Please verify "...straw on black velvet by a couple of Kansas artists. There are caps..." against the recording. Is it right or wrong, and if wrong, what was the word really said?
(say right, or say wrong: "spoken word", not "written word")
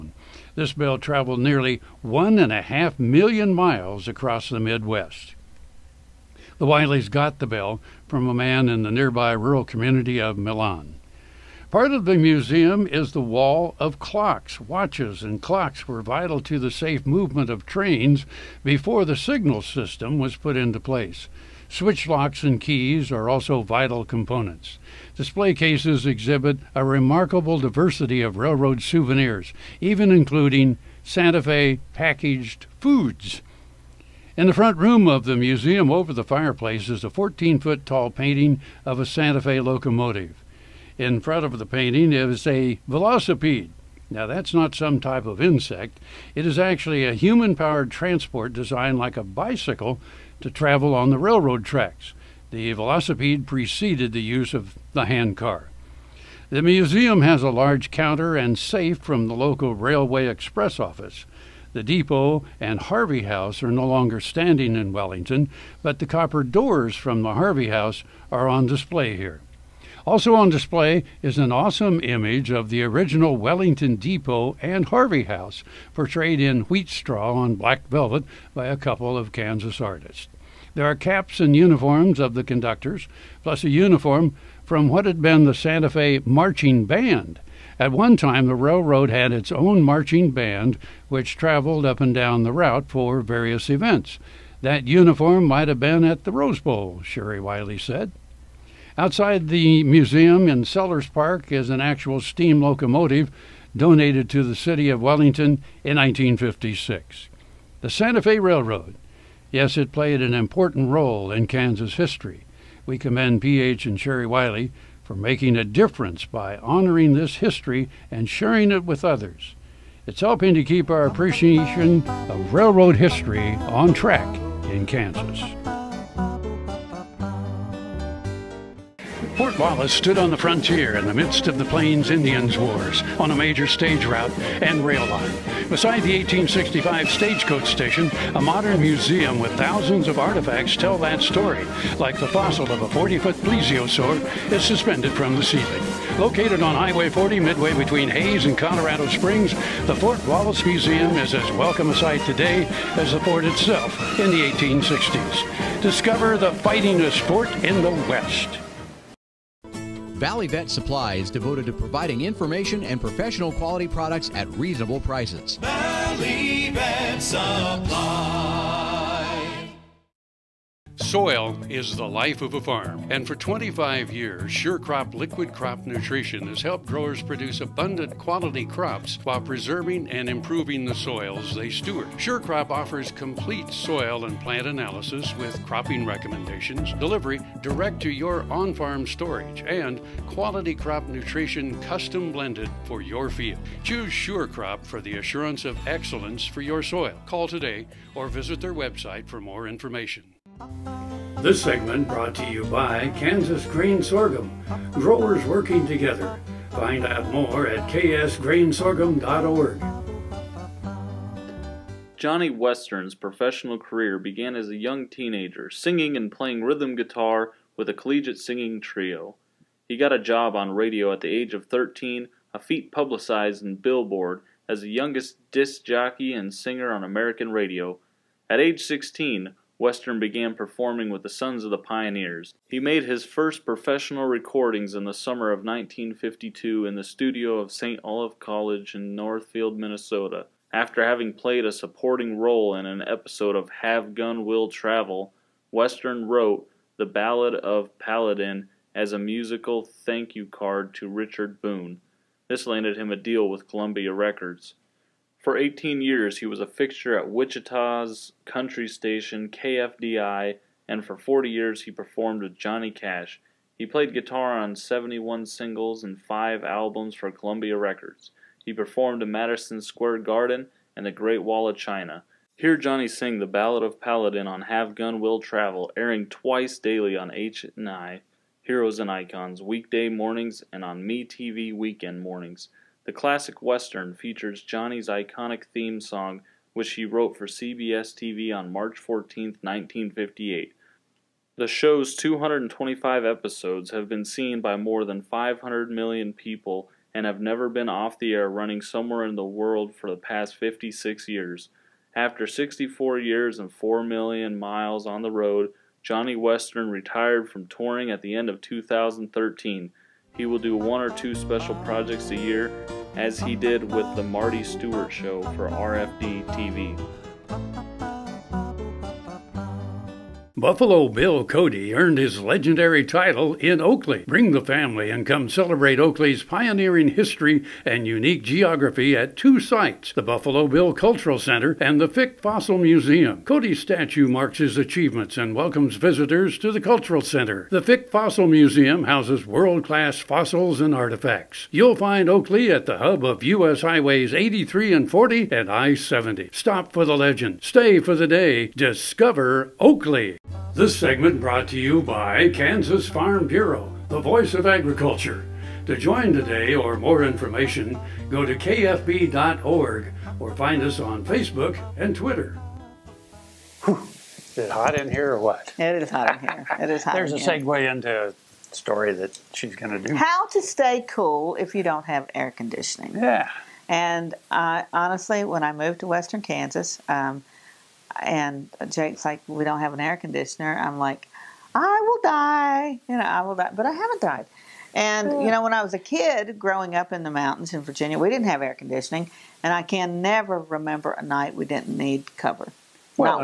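right.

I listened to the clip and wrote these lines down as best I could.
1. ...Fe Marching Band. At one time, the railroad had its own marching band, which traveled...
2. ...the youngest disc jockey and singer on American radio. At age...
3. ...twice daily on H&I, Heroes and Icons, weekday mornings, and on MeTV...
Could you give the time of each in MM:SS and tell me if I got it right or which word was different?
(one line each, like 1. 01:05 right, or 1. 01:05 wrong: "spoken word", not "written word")
1. 01:25 right
2. 03:44 right
3. 04:36 right.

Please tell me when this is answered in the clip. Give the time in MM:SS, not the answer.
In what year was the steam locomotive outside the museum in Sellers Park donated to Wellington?
01:45.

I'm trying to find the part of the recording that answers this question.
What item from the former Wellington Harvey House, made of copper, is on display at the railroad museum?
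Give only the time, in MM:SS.
01:06.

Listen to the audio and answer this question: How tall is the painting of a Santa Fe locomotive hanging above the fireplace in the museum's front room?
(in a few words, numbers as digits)
14 feet.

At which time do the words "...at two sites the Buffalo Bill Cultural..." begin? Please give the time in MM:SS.
05:29.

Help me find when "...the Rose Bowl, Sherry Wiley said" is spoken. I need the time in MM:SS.
01:36.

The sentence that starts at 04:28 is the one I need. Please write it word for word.
He performed in Madison Square Garden and the Great Wall of China.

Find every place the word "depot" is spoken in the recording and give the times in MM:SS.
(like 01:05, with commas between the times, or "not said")
01:01, 01:13.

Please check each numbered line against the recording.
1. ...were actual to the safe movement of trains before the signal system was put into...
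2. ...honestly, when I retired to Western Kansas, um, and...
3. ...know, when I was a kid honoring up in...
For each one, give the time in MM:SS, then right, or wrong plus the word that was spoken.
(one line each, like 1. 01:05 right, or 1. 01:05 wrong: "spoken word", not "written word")
1. 00:15 wrong: "vital", not "actual"
2. 06:14 wrong: "moved", not "retired"
3. 06:25 wrong: "growing", not "honoring".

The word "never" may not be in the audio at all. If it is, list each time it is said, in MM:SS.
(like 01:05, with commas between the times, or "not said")
04:57, 06:30.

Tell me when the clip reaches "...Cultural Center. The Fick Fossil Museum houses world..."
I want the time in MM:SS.
05:36.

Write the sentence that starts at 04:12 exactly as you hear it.
This landed him a deal with Columbia Records.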